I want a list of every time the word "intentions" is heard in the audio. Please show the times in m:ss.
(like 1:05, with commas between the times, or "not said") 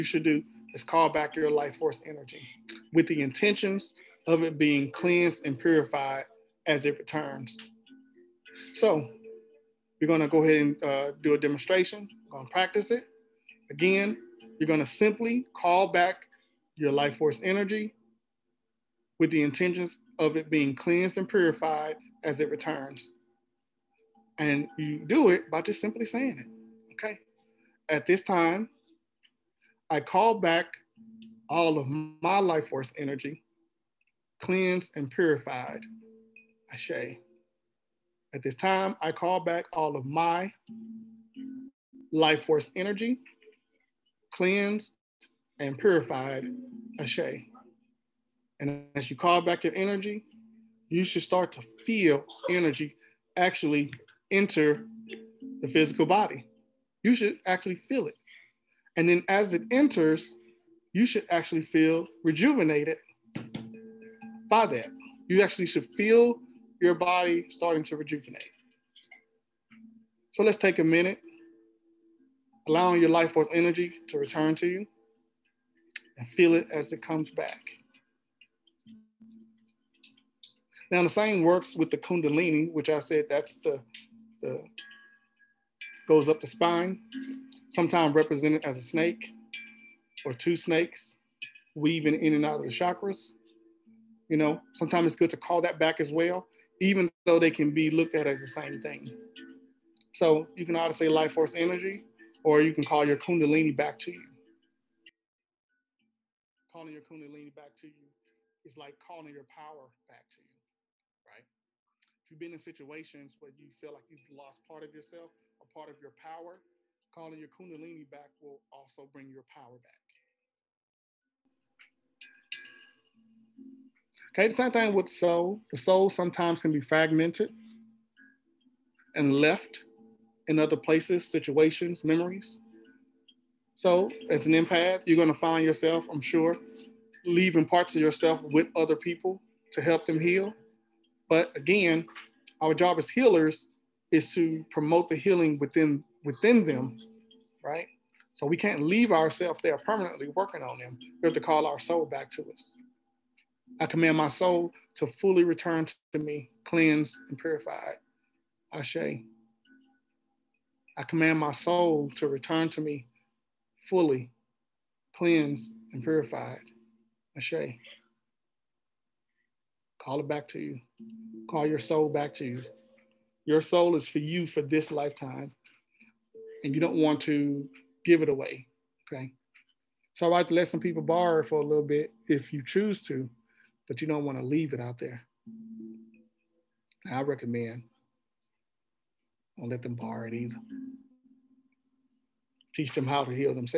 0:03, 0:19.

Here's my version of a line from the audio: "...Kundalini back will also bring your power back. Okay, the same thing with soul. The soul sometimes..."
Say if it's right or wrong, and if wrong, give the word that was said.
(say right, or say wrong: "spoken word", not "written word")
right.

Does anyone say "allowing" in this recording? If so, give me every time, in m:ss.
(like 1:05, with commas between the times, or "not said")
1:12.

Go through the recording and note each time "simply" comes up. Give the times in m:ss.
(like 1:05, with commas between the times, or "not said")
0:14, 0:25.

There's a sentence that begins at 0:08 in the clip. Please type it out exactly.
So you are going to go ahead and uh, do a demonstration.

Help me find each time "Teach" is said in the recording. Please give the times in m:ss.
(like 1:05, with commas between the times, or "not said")
3:12.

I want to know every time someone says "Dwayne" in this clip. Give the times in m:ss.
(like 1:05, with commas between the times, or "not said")
not said.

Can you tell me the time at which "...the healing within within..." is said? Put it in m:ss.
2:25.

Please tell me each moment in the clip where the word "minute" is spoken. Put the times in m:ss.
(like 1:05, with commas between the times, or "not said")
1:10.